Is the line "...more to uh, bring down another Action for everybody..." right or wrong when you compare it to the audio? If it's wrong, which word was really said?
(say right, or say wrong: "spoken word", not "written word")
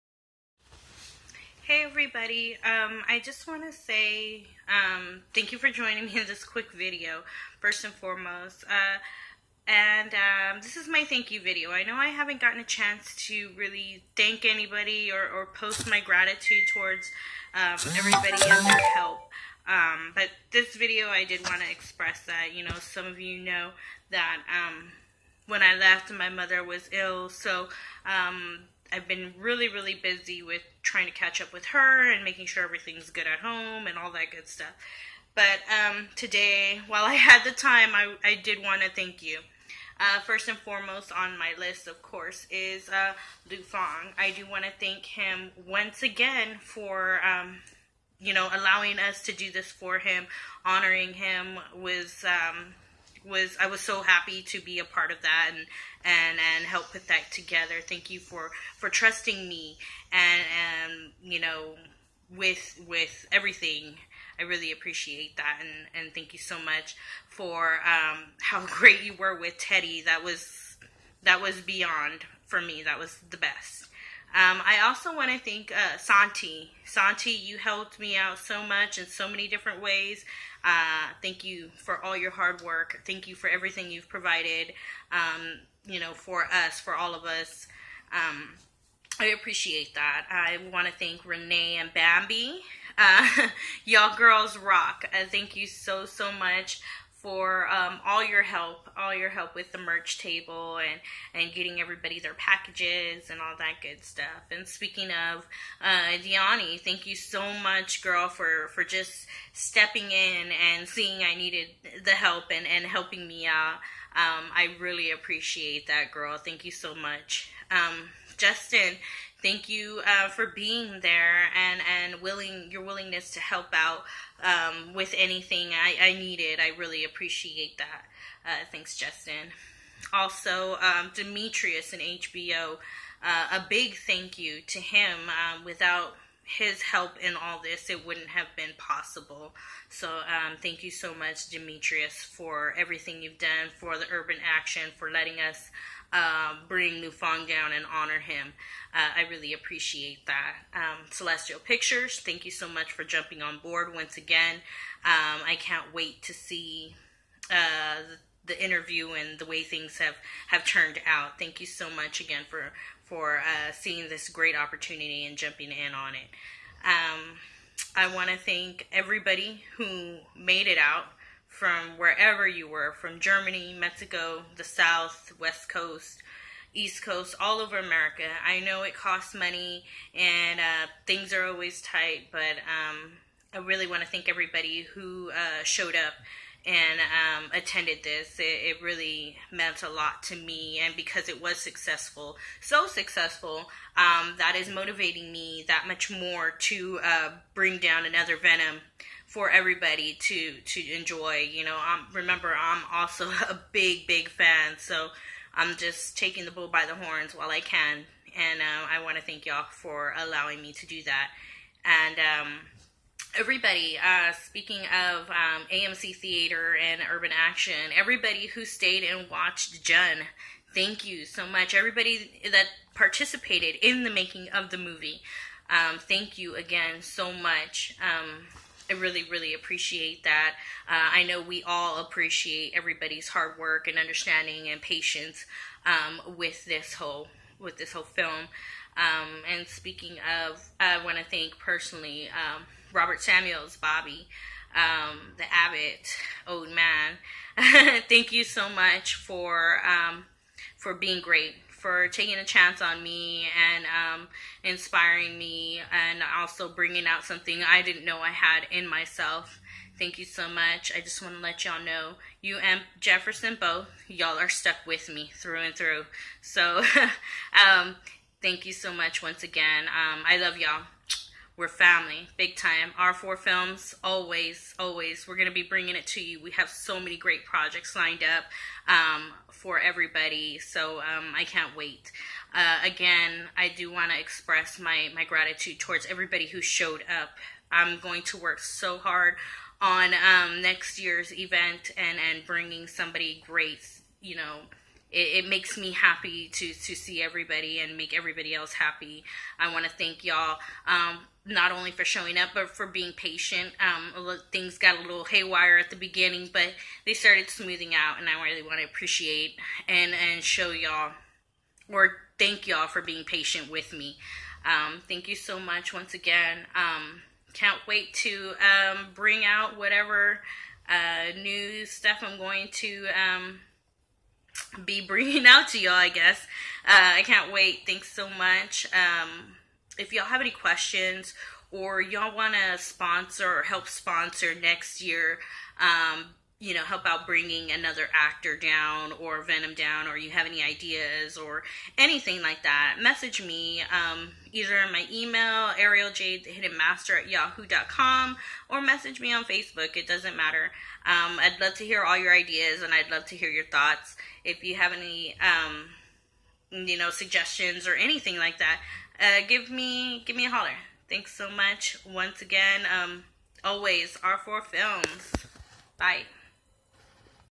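wrong: "Venom", not "Action".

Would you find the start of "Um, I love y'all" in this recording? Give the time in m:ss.
4:29.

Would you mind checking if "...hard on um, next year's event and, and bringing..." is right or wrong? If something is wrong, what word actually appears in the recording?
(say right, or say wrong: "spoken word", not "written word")
right.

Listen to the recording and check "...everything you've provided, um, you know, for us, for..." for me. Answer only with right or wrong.
right.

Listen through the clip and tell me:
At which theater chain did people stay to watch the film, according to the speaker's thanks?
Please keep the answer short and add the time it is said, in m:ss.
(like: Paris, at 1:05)
AMC, at 3:35.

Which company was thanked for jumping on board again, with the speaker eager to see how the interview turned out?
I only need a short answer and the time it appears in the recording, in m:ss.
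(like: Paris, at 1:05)
Celestial Pictures, at 2:31.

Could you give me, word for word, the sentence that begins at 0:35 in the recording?
But um, today, while I had the time, I, I did want to thank you.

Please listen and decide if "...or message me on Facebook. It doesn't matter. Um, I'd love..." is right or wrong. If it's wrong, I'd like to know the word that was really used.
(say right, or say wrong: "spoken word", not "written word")
right.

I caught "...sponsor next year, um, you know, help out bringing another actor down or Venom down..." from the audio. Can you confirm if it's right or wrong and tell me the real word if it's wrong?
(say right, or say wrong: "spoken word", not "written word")
right.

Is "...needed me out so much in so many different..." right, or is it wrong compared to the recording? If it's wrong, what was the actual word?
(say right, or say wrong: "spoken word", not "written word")
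wrong: "helped", not "needed".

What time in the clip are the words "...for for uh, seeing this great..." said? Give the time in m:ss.
2:42.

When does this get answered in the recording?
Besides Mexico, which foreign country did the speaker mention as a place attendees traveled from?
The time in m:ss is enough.
2:53.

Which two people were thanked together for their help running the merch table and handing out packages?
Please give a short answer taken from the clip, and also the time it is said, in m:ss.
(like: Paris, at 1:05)
Renee and Bambi, at 1:31.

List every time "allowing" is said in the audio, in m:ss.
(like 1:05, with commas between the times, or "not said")
0:48, 3:30.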